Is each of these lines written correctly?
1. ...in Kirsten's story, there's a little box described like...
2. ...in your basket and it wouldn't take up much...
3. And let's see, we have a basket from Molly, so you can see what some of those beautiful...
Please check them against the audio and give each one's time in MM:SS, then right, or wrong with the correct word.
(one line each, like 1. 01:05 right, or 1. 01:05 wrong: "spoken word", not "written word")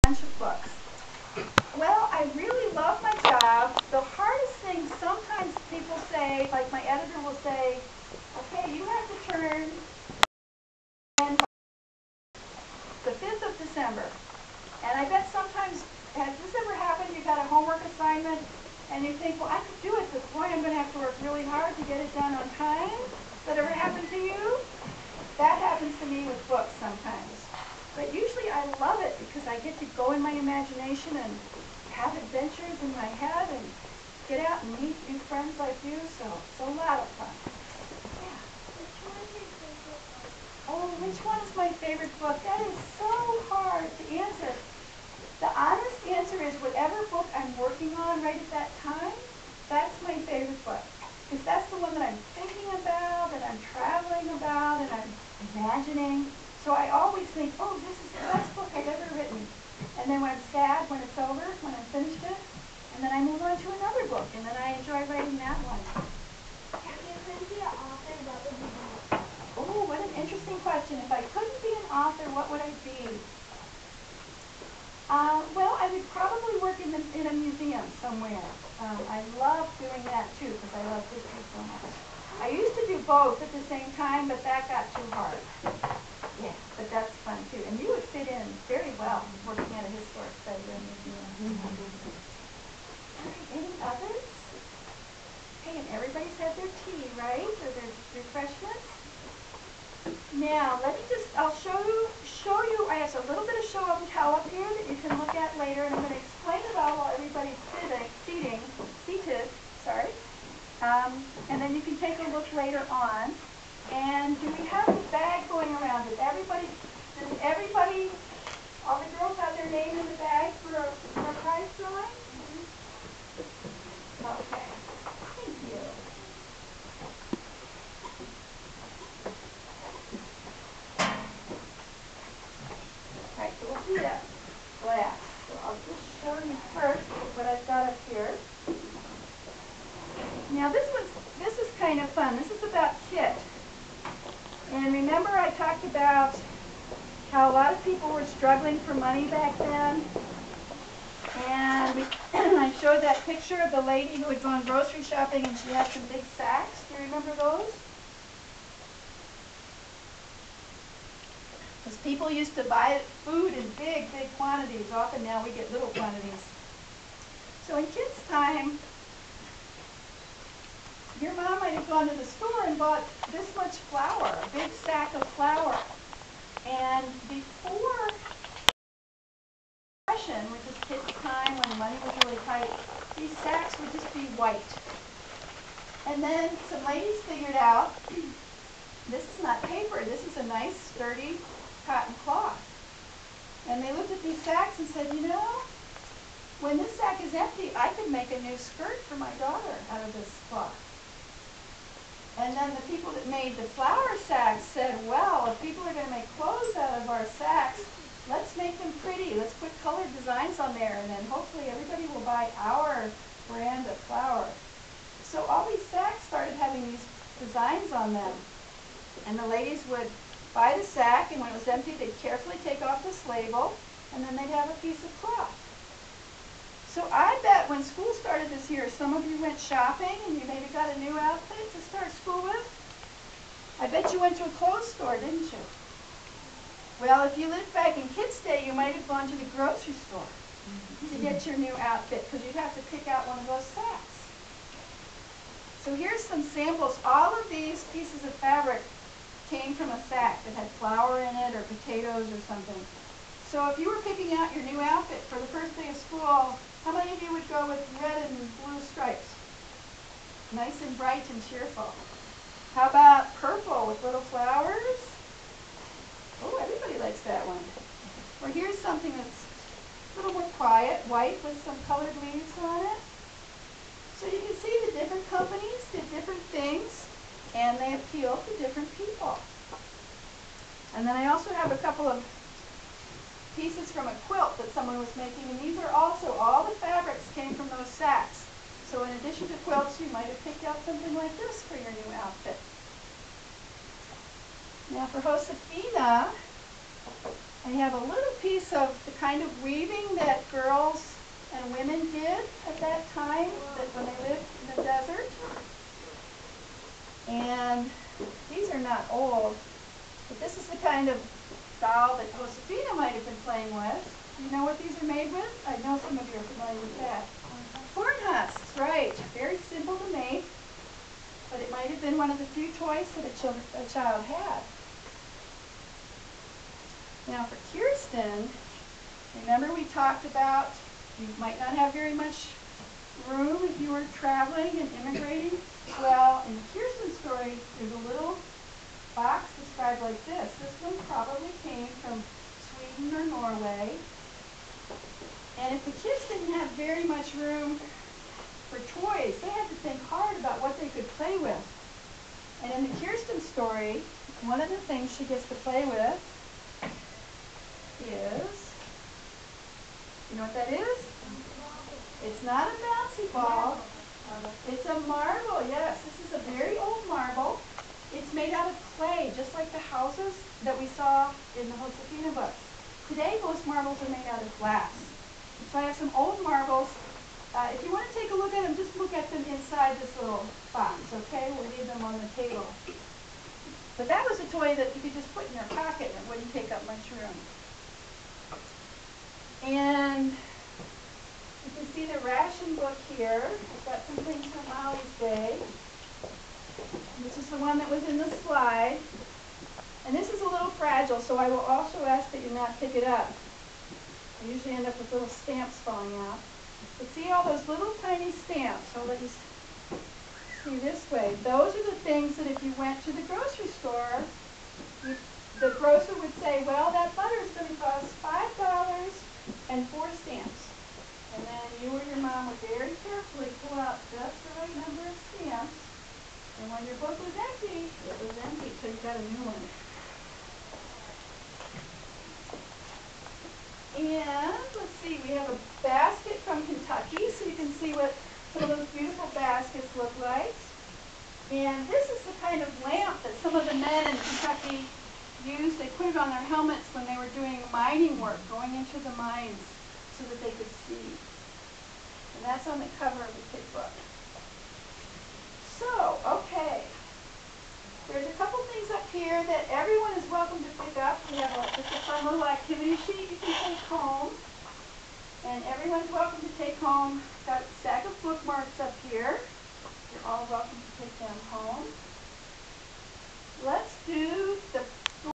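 1. 05:36 right
2. 06:25 wrong: "pocket", not "basket"
3. 07:13 wrong: "Kentucky", not "Molly".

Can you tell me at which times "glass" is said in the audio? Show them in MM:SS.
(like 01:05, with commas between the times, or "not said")
02:14, 06:14.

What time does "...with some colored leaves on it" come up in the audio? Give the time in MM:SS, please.
04:31.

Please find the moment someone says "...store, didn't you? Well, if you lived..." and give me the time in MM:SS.
03:54.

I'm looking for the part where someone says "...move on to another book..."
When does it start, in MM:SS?
01:03.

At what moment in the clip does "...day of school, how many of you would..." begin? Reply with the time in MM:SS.
04:15.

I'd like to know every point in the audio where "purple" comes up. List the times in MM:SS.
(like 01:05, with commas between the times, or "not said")
04:23.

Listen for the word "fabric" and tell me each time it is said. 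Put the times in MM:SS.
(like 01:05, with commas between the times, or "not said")
04:08, 04:46.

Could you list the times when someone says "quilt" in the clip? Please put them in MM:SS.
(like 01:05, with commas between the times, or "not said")
04:44, 04:49.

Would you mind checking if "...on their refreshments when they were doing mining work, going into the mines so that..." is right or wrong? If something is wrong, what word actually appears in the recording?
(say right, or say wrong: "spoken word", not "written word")
wrong: "helmets", not "refreshments".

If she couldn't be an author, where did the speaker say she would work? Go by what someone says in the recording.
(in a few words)
a museum.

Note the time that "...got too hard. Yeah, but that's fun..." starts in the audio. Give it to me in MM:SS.
01:24.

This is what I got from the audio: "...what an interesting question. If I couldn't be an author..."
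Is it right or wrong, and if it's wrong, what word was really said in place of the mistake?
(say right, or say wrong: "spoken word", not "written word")
right.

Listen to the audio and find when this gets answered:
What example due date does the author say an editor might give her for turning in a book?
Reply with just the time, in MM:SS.
00:13.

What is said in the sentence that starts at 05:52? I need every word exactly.
And in the Kirsten story, one of the things she gets to play with know what that is?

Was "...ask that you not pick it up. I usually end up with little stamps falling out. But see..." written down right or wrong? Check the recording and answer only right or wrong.
right.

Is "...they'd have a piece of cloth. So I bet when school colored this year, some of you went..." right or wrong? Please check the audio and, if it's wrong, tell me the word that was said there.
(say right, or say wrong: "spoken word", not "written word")
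wrong: "started", not "colored".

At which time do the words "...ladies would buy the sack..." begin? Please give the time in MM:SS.
03:39.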